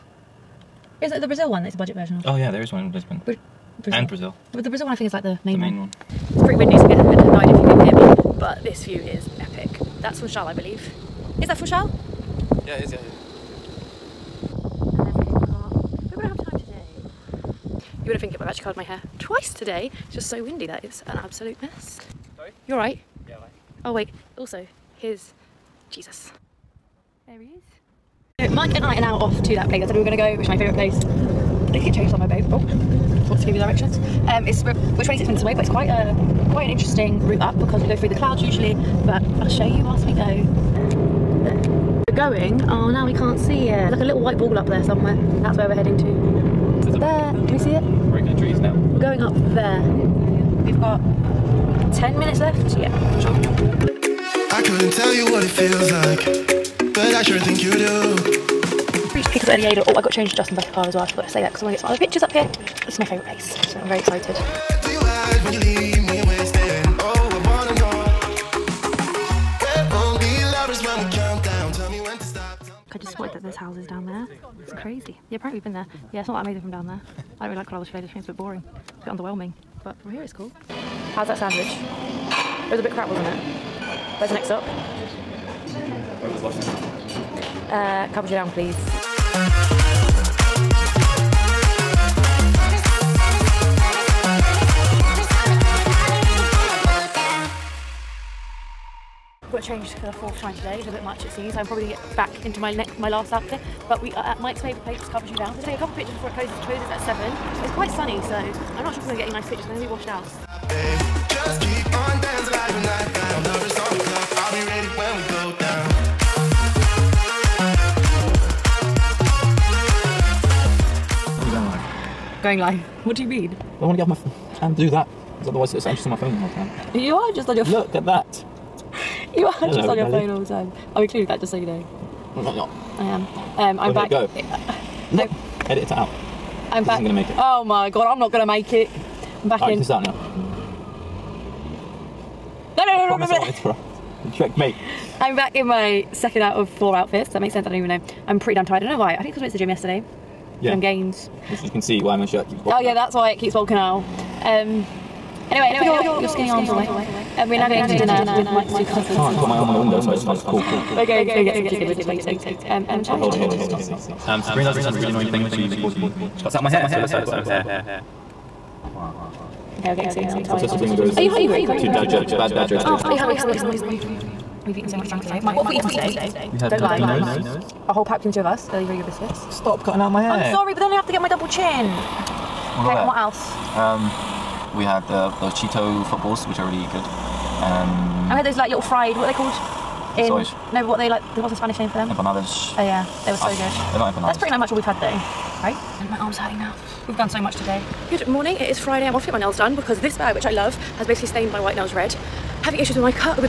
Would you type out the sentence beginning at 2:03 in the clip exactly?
Well, I want to get off my and do that.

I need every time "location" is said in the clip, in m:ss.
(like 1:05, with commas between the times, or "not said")
not said.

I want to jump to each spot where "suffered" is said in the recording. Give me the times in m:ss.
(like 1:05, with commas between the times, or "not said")
not said.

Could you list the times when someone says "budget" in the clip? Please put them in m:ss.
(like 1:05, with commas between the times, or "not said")
0:01.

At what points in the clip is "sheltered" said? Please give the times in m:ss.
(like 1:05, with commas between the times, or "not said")
not said.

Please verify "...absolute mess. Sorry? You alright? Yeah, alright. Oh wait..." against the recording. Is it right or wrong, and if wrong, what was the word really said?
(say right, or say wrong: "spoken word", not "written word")
right.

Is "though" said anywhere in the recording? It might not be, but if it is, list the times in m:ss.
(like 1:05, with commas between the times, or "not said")
3:15.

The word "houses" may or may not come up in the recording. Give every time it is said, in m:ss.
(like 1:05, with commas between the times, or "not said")
1:13.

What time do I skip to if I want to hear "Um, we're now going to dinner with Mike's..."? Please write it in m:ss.
2:37.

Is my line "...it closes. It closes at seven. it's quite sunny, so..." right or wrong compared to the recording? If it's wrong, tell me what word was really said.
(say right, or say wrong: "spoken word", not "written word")
right.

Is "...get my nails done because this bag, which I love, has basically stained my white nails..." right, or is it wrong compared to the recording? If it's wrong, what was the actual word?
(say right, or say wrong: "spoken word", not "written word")
right.